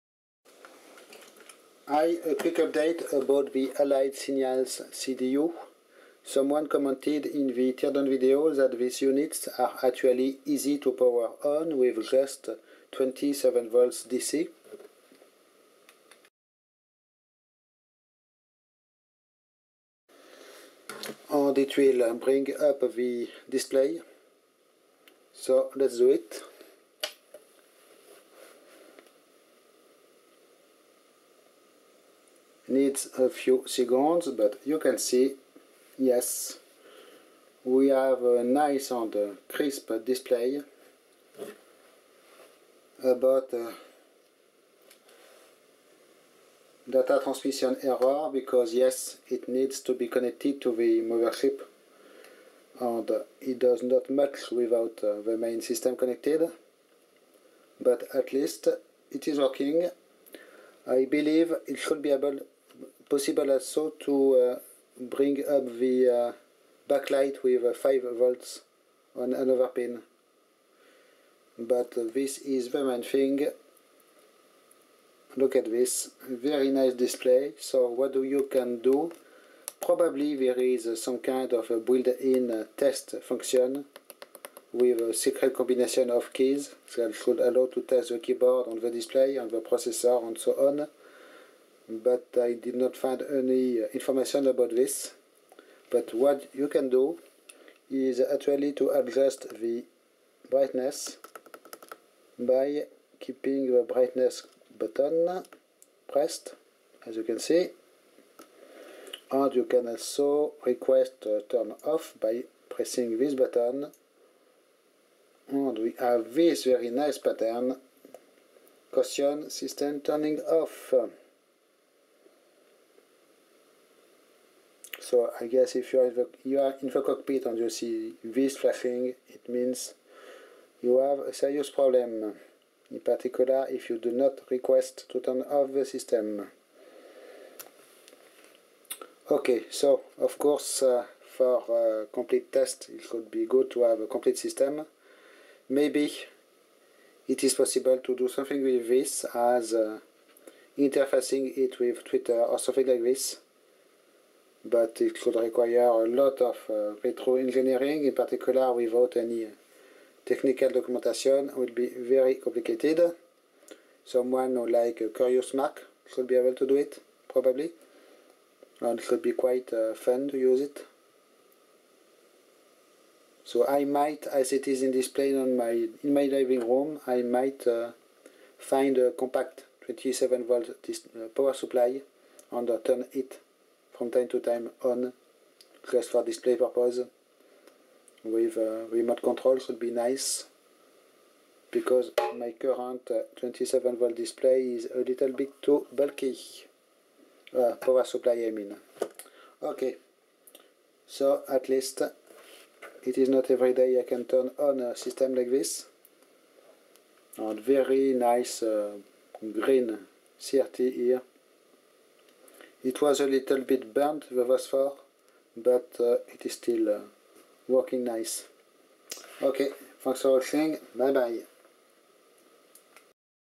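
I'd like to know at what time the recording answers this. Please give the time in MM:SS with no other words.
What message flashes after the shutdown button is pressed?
01:58.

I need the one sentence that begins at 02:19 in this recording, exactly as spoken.
Okay, so of course uh, for uh, complete test it could be good to have a complete system.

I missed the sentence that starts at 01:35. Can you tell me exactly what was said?
But what you can do is actually to adjust the brightness by keeping the brightness button pressed, as you can see.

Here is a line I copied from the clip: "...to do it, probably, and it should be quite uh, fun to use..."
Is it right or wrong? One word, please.
right.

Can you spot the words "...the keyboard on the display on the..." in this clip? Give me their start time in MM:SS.
01:28.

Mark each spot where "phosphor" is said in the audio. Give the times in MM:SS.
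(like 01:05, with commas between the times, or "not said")
03:34.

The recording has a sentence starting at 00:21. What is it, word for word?
And it will bring up the display.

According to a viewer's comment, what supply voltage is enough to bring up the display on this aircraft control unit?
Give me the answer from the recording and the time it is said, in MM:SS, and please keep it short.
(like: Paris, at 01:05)
27 volts DC, at 00:12.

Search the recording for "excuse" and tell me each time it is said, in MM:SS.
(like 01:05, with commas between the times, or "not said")
not said.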